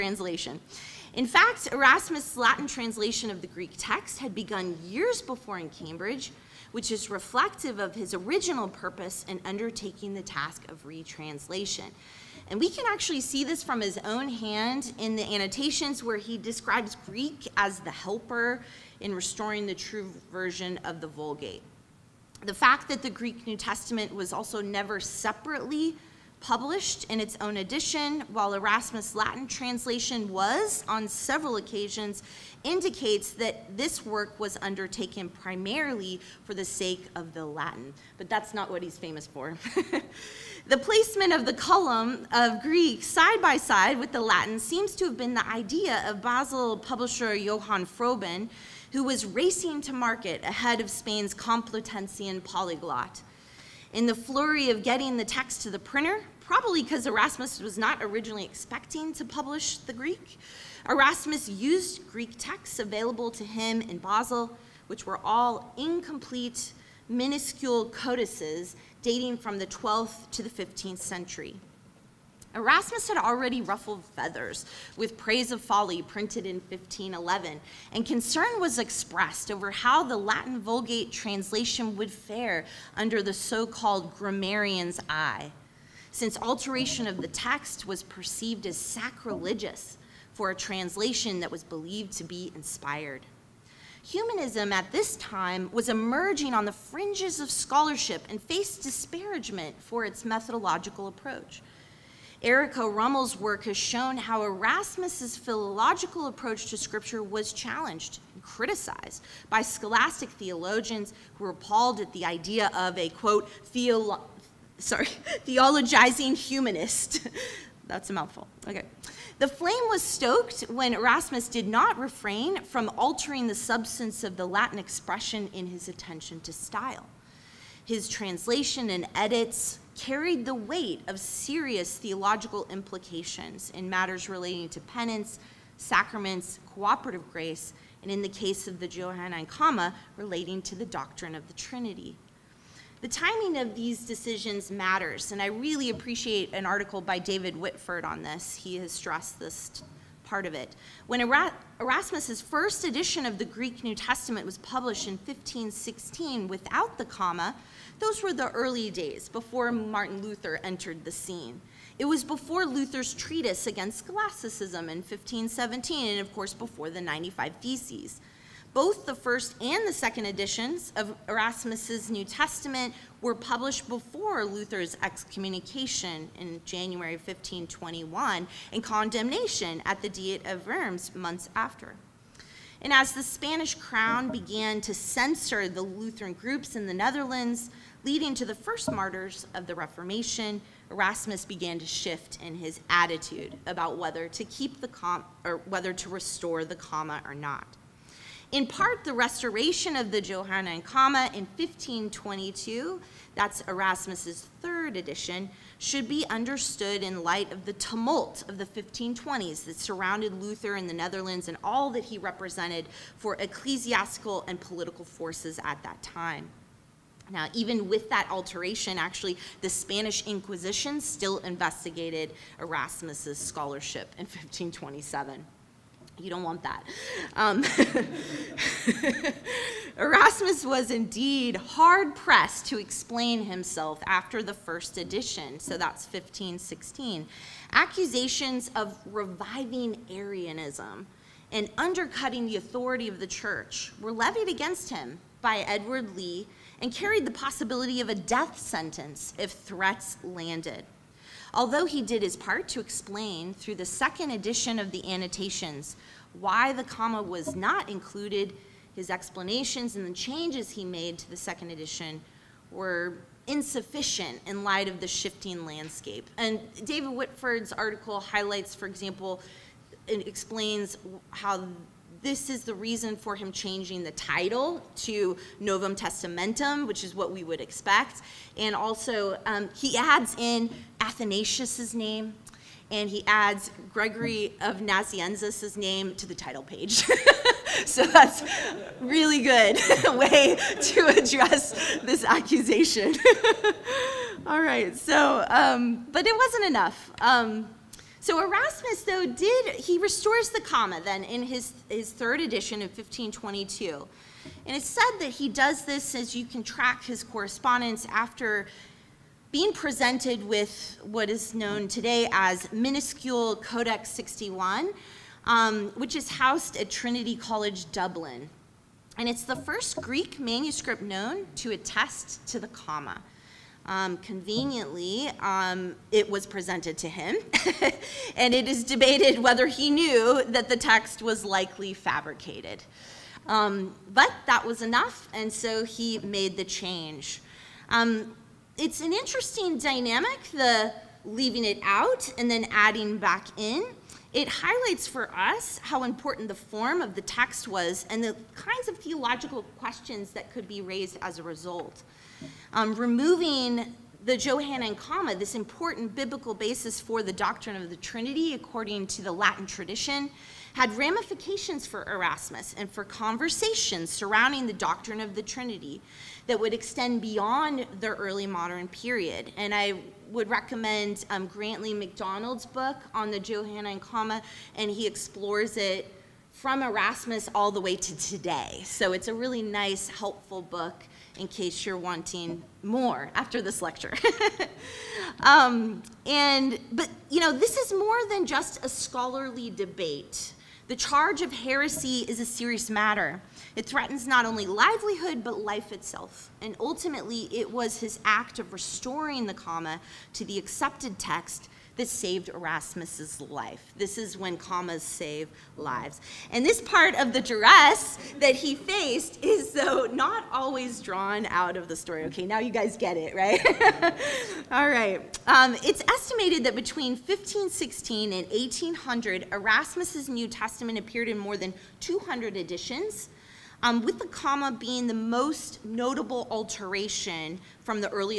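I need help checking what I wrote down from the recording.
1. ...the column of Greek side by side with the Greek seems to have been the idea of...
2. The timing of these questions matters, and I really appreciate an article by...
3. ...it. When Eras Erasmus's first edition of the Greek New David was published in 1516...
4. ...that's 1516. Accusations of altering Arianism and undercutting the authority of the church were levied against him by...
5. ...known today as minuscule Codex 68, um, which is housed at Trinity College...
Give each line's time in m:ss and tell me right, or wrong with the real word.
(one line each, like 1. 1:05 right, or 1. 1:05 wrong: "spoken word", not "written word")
1. 0:41 wrong: "Latin", not "Greek"
2. 2:23 wrong: "decisions", not "questions"
3. 2:30 wrong: "Testament", not "David"
4. 3:55 wrong: "reviving", not "altering"
5. 5:11 wrong: "61", not "68".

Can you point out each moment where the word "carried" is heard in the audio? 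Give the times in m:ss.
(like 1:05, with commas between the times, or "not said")
2:09, 4:06.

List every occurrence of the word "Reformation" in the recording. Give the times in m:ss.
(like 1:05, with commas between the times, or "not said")
3:09.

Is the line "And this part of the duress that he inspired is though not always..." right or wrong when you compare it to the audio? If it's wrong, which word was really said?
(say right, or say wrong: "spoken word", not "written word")
wrong: "faced", not "inspired".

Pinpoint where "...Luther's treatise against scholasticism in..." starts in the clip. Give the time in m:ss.
2:42.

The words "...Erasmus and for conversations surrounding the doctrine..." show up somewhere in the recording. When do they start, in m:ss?
6:02.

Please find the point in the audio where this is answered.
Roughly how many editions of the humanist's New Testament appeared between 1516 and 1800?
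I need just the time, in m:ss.
7:01.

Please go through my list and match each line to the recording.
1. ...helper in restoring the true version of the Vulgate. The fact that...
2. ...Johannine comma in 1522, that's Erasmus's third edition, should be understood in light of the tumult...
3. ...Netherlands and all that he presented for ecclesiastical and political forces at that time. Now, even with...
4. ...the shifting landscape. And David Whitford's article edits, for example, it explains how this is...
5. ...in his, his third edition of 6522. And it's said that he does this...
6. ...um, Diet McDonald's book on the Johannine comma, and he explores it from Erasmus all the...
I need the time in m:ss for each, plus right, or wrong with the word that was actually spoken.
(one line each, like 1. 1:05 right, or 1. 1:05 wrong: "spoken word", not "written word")
1. 0:17 right
2. 3:20 right
3. 3:30 wrong: "represented", not "presented"
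4. 4:24 wrong: "highlights", not "edits"
5. 5:01 wrong: "1522", not "6522"
6. 6:11 wrong: "Grantley", not "Diet".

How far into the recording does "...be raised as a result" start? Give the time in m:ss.
5:50.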